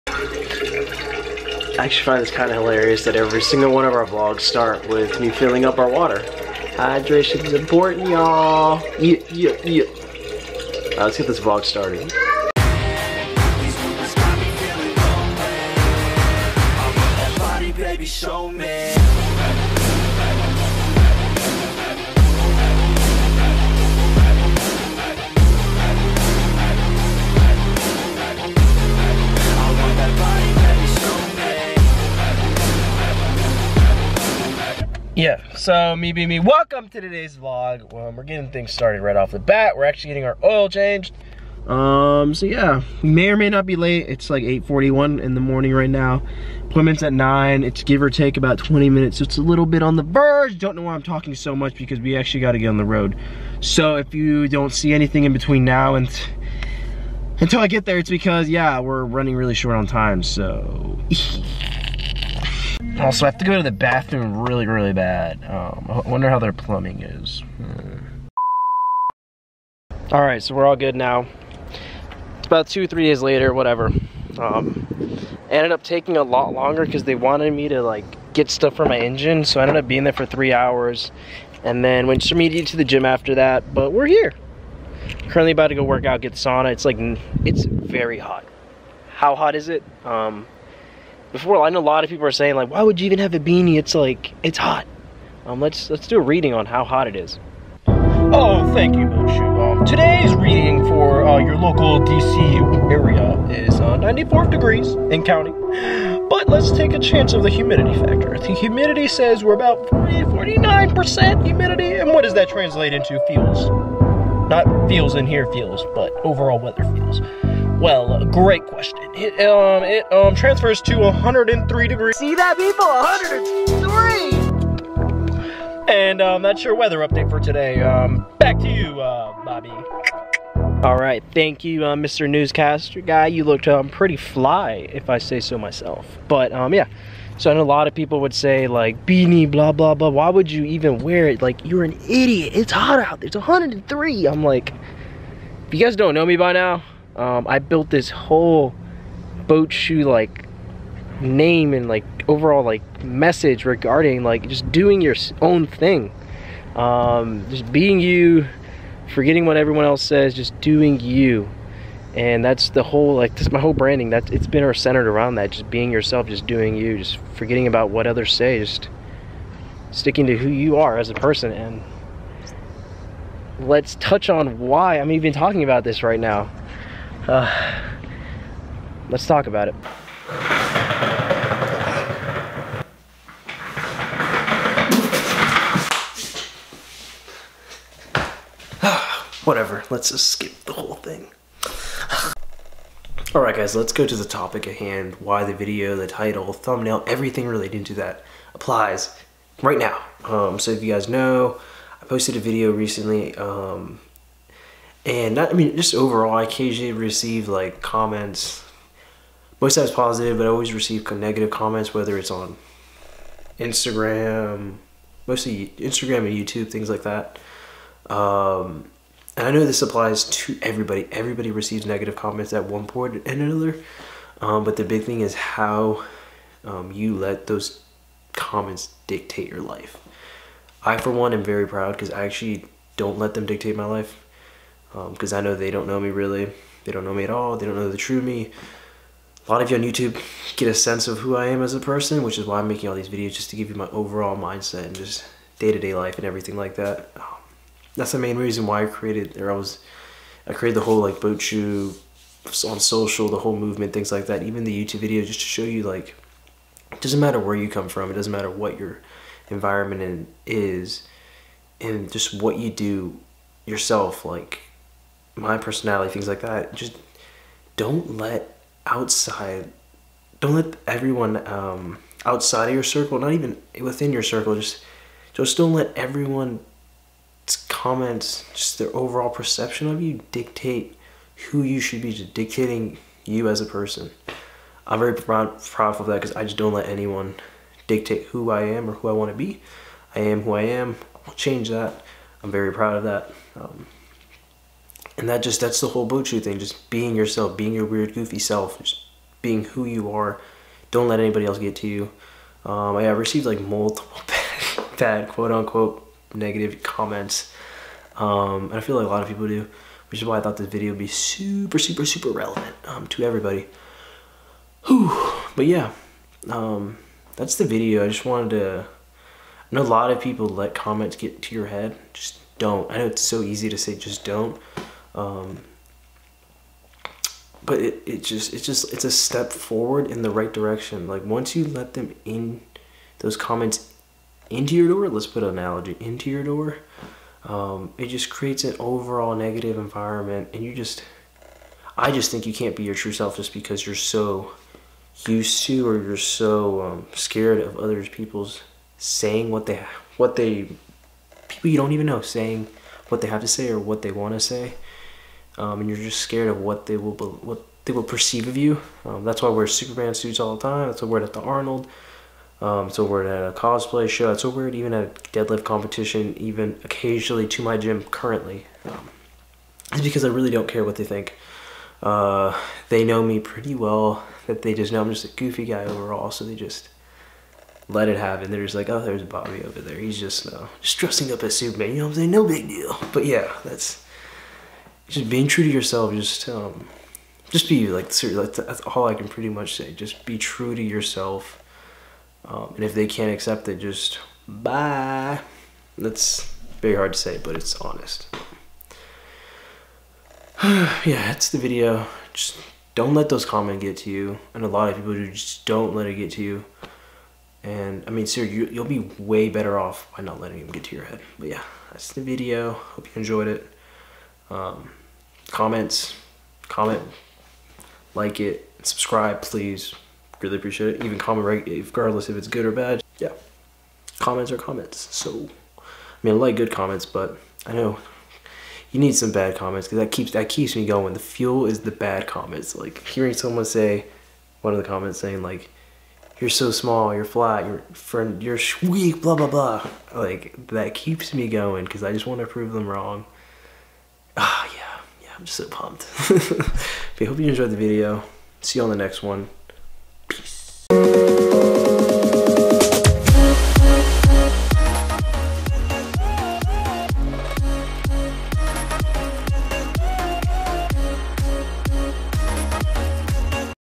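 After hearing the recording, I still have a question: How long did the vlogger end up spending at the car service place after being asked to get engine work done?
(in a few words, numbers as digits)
three hours.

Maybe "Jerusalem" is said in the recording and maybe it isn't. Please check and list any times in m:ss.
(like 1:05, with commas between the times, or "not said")
not said.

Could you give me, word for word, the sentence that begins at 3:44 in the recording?
Um, but the big thing is how um, you let those comments dictate your life.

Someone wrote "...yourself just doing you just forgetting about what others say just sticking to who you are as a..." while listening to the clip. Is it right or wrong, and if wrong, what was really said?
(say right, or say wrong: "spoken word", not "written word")
right.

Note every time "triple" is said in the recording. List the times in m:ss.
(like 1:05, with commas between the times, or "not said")
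not said.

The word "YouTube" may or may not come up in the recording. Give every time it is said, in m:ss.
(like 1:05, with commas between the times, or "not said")
3:36, 3:59, 4:14.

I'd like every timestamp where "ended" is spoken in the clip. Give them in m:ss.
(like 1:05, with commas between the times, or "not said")
1:15, 1:19.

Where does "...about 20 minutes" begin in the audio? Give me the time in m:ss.
0:48.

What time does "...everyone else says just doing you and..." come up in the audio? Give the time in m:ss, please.
2:39.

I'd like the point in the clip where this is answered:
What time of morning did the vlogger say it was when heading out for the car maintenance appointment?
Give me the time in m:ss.
0:44.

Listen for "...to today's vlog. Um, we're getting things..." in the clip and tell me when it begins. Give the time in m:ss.
0:36.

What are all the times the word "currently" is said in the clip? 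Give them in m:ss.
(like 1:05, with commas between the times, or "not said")
1:25, 6:08.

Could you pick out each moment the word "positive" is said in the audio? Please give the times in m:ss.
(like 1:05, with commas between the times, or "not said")
3:29.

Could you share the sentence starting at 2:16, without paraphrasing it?
But um, yeah, so I know a lot of people would say like beanie, blah blah blah.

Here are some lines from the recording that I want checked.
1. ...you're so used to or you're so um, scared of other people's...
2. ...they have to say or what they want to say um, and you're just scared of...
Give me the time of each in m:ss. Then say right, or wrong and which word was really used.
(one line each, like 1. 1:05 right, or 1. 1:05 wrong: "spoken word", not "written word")
1. 5:43 right
2. 5:53 right.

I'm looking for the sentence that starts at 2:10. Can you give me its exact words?
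All right, thank you, uh, Mr.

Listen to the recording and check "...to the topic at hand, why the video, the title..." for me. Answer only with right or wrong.
right.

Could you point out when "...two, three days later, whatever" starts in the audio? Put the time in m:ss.
1:12.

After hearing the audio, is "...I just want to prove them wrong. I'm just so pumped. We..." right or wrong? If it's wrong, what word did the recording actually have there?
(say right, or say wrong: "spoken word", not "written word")
right.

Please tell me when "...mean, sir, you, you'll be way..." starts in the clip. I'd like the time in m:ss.
6:48.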